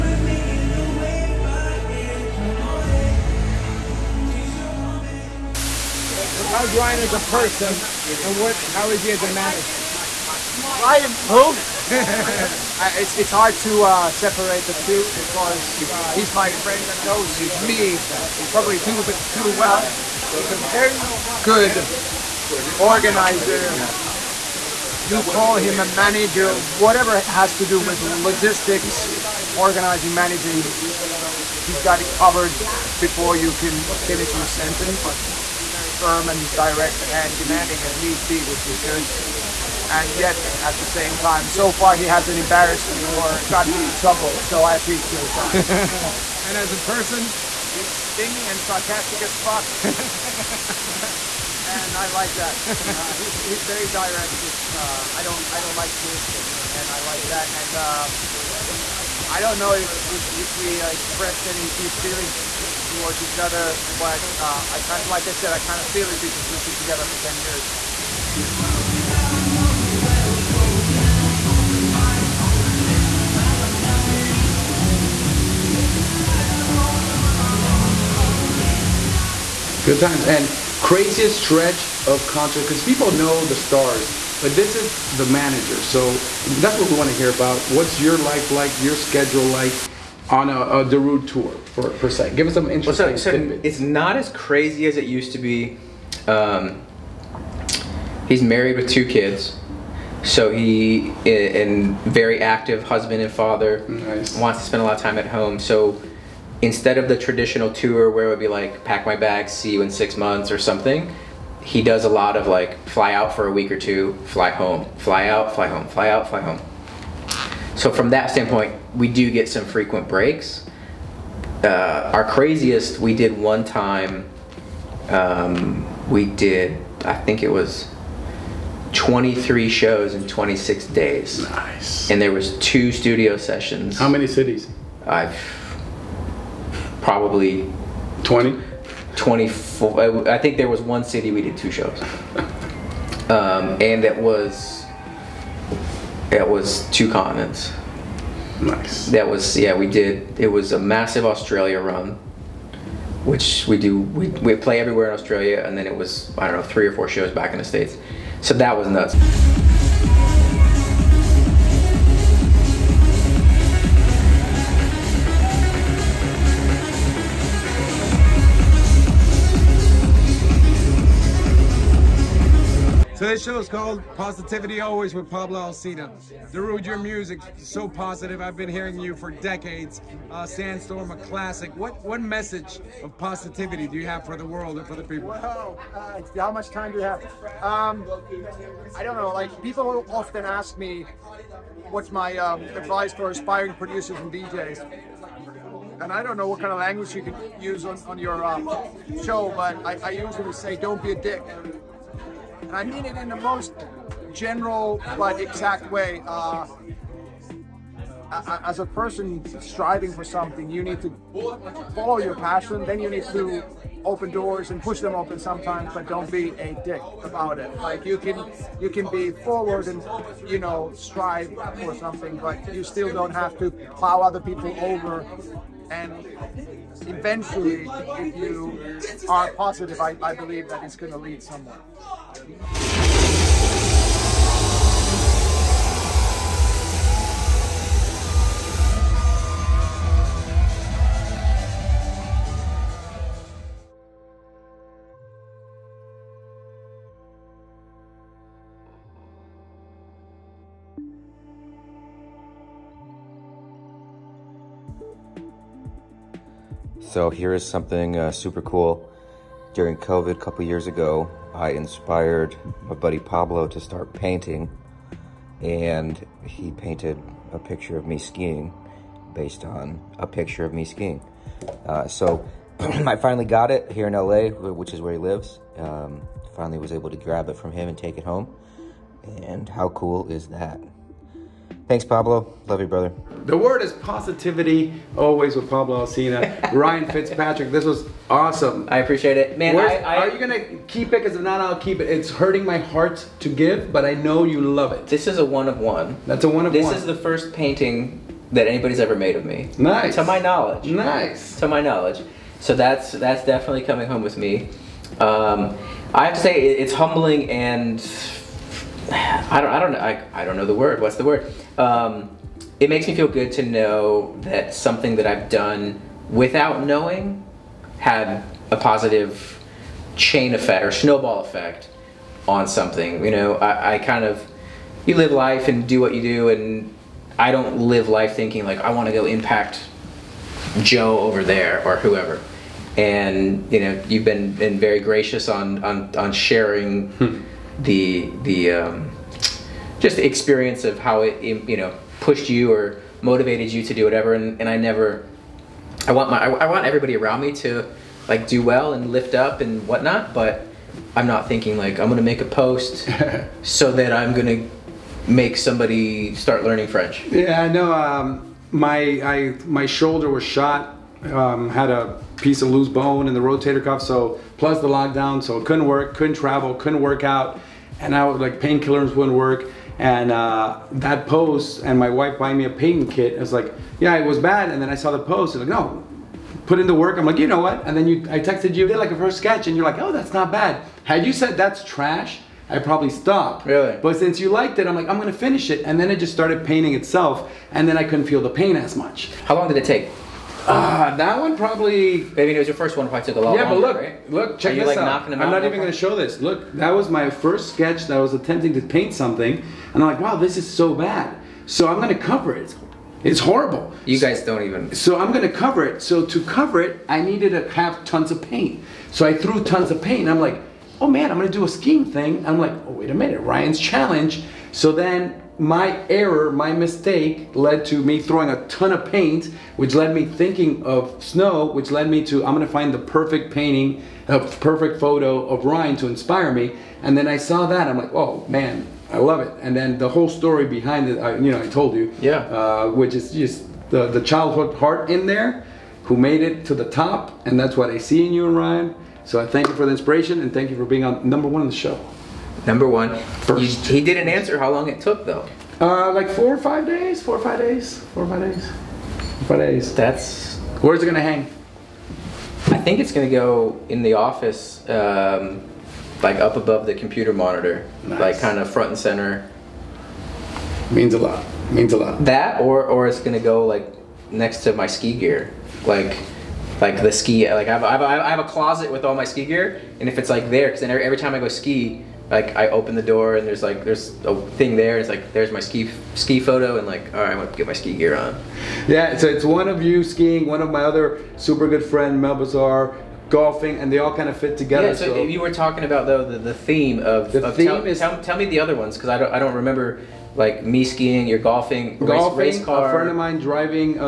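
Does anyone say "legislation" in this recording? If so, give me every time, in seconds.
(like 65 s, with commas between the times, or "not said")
not said.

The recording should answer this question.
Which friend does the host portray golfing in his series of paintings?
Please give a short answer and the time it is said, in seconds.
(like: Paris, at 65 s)
Mel Bazaar, at 482 s.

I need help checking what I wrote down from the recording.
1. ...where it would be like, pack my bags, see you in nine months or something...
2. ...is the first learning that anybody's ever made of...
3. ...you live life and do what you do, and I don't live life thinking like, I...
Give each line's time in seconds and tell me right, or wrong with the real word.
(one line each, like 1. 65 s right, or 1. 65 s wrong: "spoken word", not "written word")
1. 108 s wrong: "six", not "nine"
2. 297 s wrong: "painting", not "learning"
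3. 325 s right.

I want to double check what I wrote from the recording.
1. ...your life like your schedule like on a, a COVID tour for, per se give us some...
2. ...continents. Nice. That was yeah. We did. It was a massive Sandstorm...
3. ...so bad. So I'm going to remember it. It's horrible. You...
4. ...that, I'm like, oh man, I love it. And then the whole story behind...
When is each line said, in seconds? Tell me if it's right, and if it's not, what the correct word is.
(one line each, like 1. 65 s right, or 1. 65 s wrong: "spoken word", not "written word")
1. 87 s wrong: "Darude", not "COVID"
2. 147 s wrong: "Australia", not "Sandstorm"
3. 400 s wrong: "cover", not "remember"
4. 427 s right.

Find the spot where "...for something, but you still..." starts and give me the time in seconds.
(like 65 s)
221 s.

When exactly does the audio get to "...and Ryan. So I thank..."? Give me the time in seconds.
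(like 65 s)
438 s.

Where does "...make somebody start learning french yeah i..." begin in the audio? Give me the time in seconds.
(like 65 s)
355 s.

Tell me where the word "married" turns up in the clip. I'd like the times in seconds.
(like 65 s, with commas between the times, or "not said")
98 s.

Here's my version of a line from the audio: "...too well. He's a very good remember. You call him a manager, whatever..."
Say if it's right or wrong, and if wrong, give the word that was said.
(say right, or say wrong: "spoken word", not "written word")
wrong: "organizer", not "remember".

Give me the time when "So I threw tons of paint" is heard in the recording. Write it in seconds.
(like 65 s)
409 s.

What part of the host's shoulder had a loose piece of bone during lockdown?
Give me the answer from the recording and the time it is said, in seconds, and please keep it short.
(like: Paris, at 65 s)
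rotator cuff, at 363 s.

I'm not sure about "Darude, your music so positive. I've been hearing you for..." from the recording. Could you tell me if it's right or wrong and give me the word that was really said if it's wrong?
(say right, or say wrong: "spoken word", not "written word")
right.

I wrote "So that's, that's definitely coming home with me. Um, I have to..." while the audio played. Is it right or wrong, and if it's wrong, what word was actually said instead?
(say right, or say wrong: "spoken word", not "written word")
right.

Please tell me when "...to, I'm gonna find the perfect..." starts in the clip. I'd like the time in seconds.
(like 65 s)
422 s.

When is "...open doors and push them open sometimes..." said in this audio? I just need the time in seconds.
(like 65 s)
214 s.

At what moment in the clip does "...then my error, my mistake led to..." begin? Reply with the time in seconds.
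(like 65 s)
414 s.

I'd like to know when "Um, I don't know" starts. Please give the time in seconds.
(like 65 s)
187 s.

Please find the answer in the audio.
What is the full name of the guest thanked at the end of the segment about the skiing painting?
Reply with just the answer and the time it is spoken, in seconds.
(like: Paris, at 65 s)
Ryan Fitzpatrick, at 286 s.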